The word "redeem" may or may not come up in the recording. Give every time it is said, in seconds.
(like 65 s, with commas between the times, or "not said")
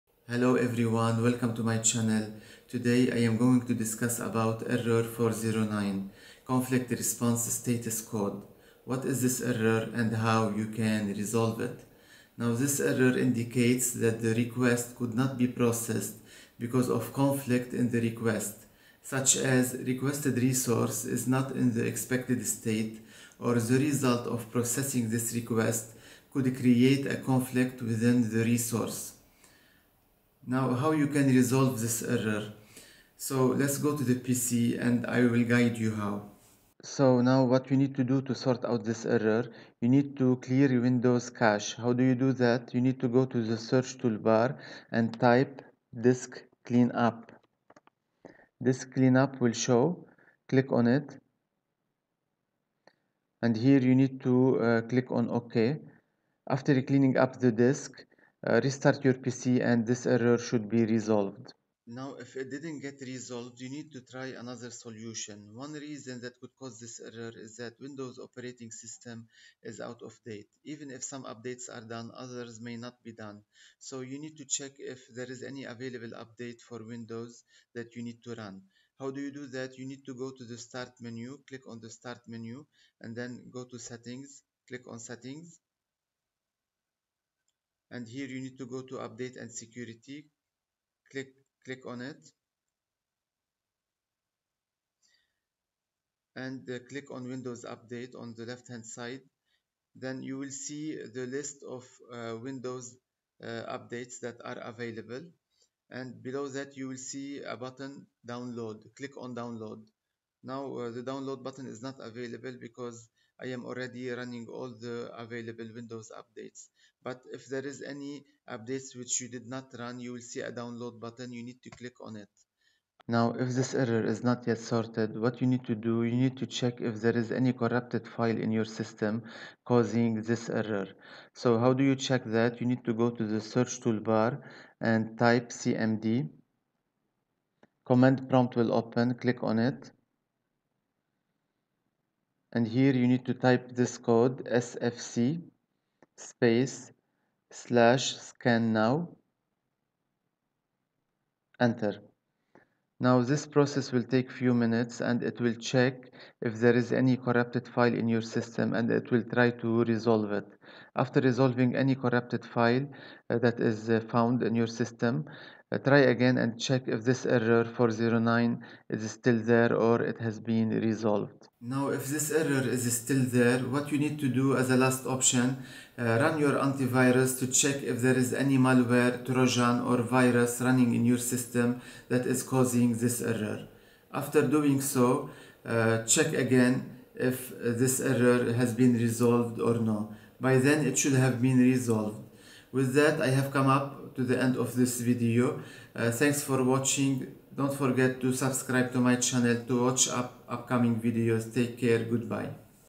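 not said.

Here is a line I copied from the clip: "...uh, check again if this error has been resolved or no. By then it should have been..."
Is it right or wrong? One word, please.
right.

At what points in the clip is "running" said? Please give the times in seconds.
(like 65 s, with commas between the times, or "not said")
114 s, 180 s.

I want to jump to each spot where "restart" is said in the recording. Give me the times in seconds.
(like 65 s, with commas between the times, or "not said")
58 s.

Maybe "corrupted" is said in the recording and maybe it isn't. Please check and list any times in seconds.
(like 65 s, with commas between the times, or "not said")
127 s, 157 s, 161 s.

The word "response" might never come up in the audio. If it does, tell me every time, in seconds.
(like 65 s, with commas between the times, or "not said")
6 s.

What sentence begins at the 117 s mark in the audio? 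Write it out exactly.
But if there is any updates which you did not run, you will see a download button.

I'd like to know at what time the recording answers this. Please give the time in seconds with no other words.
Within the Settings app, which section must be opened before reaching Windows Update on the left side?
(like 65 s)
88 s.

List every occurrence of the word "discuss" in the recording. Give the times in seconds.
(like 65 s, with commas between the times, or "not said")
3 s.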